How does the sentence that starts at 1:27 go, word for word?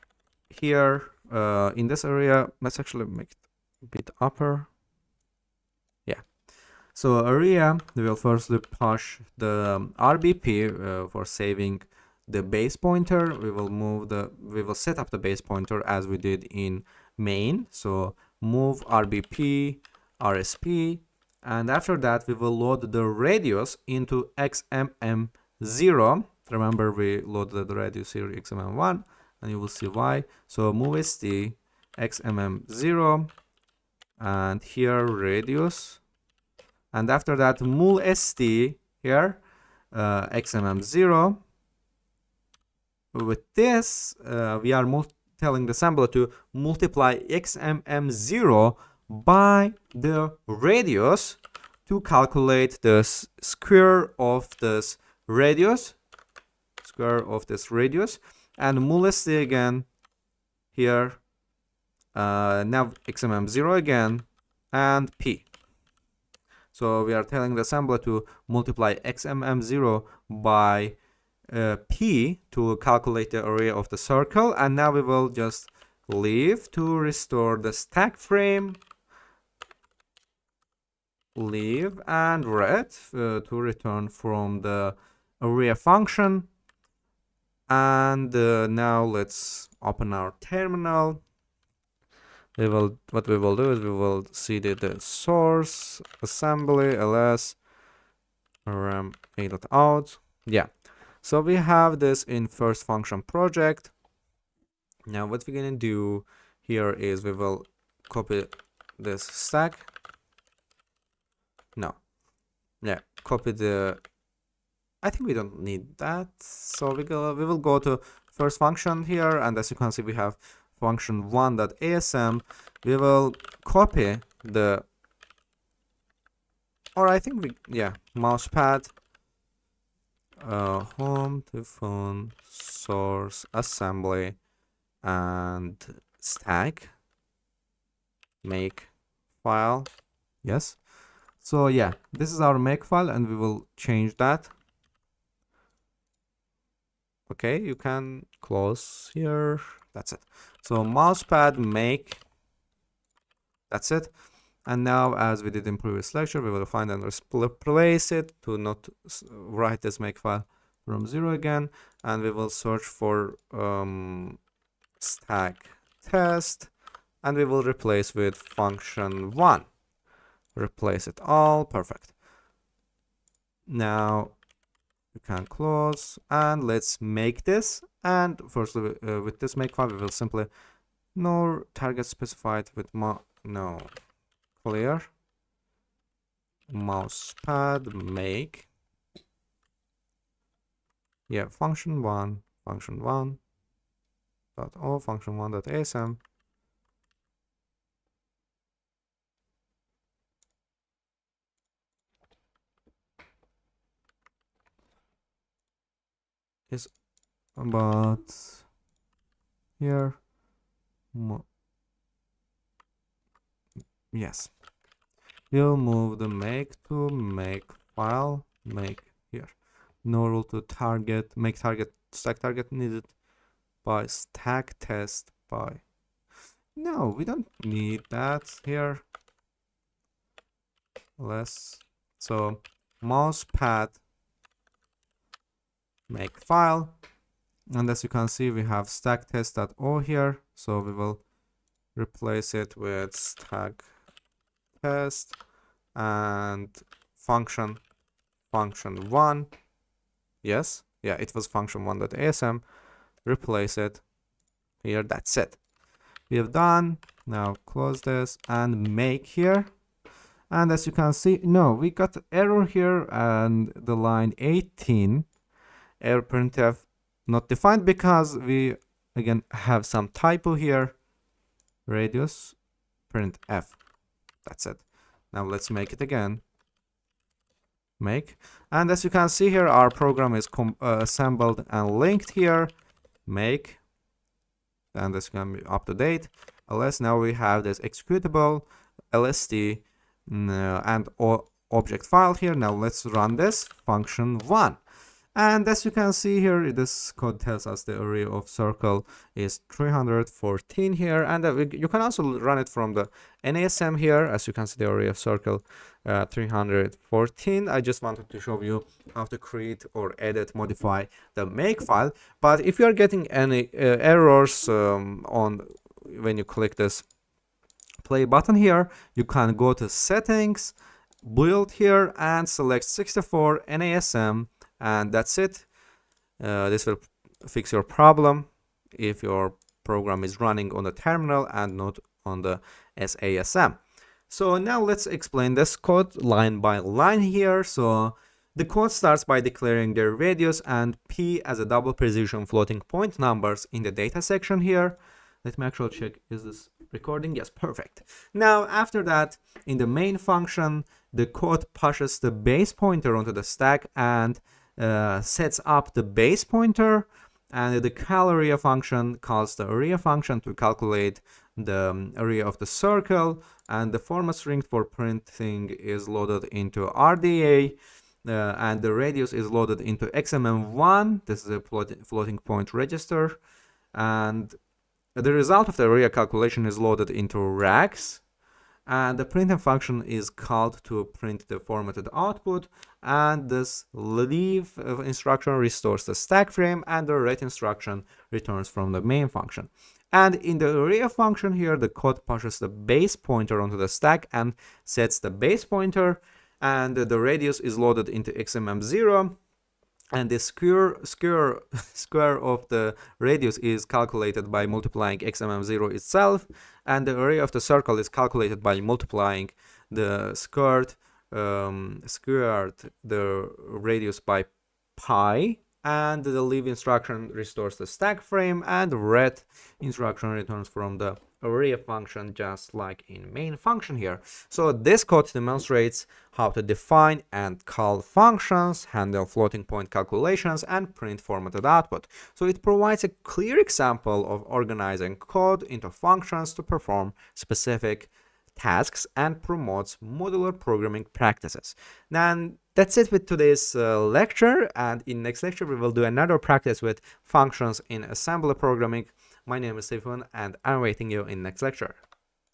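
And uh, now let's open our terminal.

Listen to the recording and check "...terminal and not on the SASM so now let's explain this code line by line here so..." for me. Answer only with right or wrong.
right.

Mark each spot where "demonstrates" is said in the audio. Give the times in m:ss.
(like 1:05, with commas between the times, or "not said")
7:05.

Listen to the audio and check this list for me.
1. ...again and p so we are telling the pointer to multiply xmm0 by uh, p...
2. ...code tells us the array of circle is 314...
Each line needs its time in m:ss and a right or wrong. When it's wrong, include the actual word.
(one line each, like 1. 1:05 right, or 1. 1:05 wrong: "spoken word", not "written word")
1. 1:03 wrong: "assembler", not "pointer"
2. 4:57 right.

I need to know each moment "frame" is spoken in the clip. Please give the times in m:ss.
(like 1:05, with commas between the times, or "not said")
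1:18, 6:26, 6:58.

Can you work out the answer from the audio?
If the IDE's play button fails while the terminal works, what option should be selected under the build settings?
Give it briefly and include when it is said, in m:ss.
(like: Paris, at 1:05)
64 NASM, at 5:22.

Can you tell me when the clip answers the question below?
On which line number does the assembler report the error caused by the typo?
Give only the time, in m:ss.
4:23.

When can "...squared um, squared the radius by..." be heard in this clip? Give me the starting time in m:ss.
6:50.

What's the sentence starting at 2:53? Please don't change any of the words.
Now we can close and let's make this.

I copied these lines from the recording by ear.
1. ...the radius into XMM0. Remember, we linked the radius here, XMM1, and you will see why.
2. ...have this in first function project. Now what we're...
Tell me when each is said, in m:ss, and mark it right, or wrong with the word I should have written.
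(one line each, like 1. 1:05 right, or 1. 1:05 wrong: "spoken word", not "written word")
1. 0:22 wrong: "loaded", not "linked"
2. 1:41 right.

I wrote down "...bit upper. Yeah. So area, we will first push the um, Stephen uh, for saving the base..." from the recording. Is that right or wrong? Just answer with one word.
wrong.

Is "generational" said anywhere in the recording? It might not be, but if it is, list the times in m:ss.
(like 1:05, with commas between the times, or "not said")
not said.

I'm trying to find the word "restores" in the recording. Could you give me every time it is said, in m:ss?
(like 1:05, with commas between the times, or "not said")
1:16, 6:25, 6:57.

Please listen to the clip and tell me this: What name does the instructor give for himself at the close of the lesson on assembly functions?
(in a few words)
Stephen.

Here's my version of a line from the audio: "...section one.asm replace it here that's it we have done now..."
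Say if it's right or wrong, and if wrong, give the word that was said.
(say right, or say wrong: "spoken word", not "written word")
wrong: "function", not "section".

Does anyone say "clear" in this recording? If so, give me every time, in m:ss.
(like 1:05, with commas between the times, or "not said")
3:04, 7:13.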